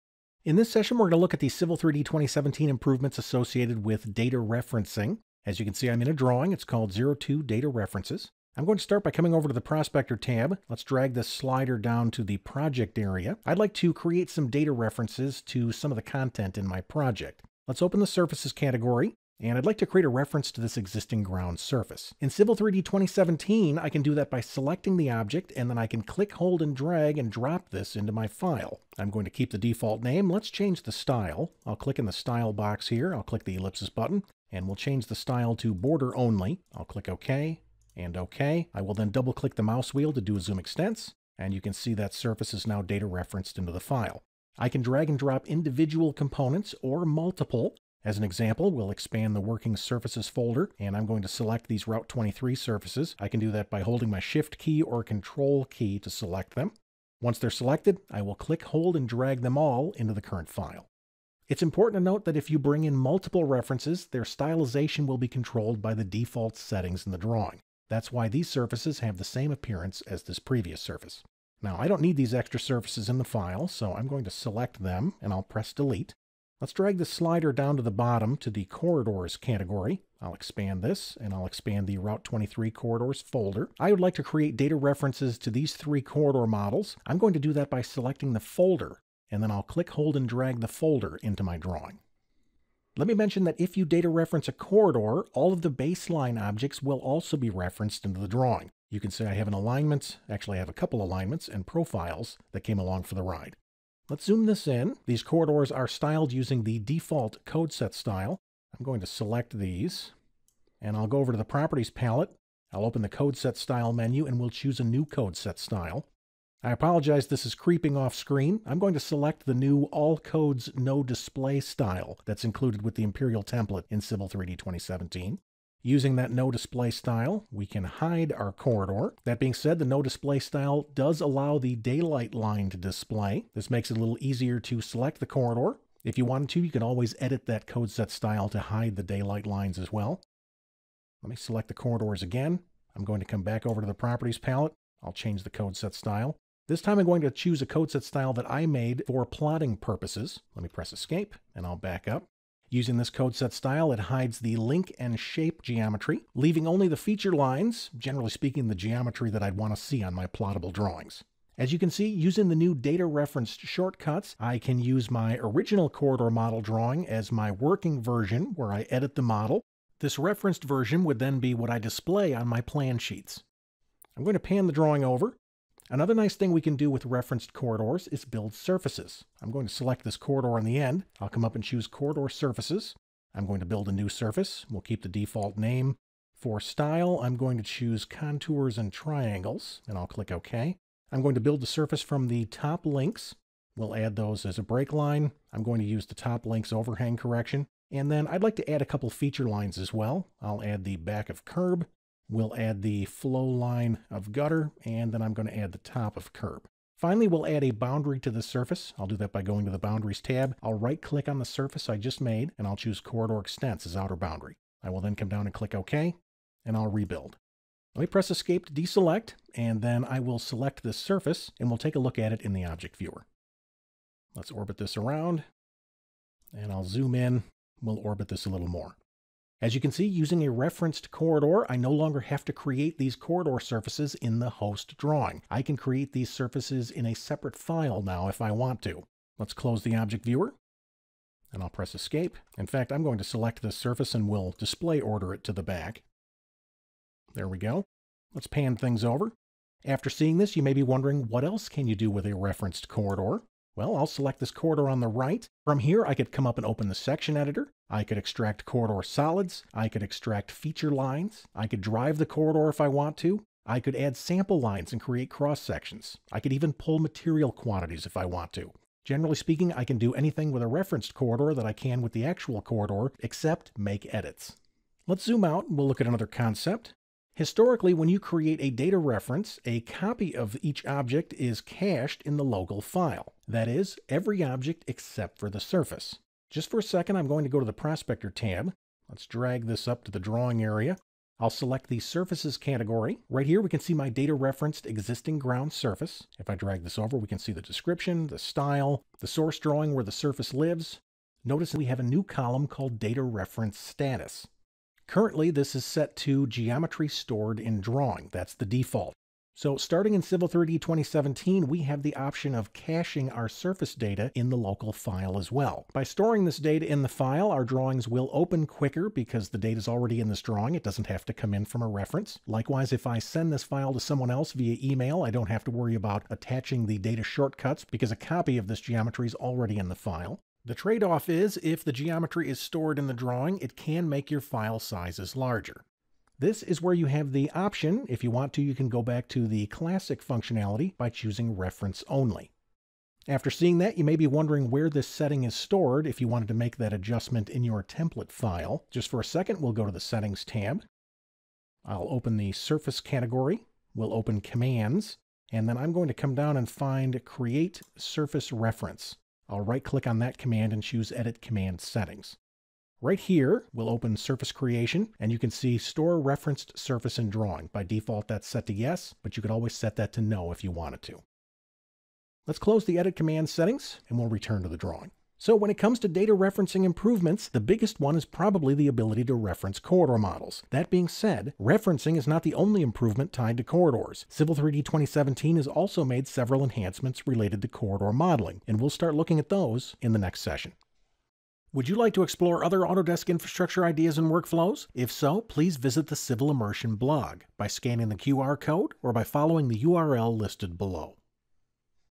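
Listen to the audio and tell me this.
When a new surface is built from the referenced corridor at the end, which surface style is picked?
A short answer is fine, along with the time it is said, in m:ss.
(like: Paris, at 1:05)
Contours and Triangles, at 3:08.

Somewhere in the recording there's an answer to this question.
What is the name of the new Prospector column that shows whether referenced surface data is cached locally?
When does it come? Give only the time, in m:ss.
5:02.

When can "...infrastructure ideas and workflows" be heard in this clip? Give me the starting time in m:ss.
6:33.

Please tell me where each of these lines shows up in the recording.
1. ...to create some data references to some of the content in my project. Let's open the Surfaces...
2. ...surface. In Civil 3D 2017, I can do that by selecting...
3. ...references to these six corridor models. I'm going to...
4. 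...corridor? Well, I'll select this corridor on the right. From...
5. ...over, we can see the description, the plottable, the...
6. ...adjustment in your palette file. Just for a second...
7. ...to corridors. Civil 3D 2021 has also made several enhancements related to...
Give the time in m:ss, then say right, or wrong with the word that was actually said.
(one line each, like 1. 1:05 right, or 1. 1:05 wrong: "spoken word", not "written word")
1. 0:13 right
2. 0:21 right
3. 1:24 wrong: "three", not "six"
4. 4:12 right
5. 4:56 wrong: "style", not "plottable"
6. 5:46 wrong: "template", not "palette"
7. 6:23 wrong: "2017", not "2021".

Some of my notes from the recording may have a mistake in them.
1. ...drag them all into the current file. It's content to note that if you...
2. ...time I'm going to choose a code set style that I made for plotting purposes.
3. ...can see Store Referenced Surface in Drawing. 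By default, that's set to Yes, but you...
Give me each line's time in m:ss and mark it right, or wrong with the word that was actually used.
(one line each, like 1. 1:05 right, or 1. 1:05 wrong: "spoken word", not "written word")
1. 0:59 wrong: "important", not "content"
2. 2:26 right
3. 6:05 right.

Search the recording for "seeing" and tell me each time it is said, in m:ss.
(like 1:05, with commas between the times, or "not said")
4:10, 5:43.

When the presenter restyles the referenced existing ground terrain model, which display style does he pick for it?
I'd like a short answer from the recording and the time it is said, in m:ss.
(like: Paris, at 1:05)
Border only, at 0:35.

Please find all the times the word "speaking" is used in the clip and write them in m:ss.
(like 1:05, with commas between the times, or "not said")
2:38, 4:29.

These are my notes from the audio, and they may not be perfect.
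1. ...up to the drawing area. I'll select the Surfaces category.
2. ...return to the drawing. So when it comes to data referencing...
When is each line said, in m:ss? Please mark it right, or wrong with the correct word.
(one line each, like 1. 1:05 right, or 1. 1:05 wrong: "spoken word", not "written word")
1. 4:49 right
2. 6:14 right.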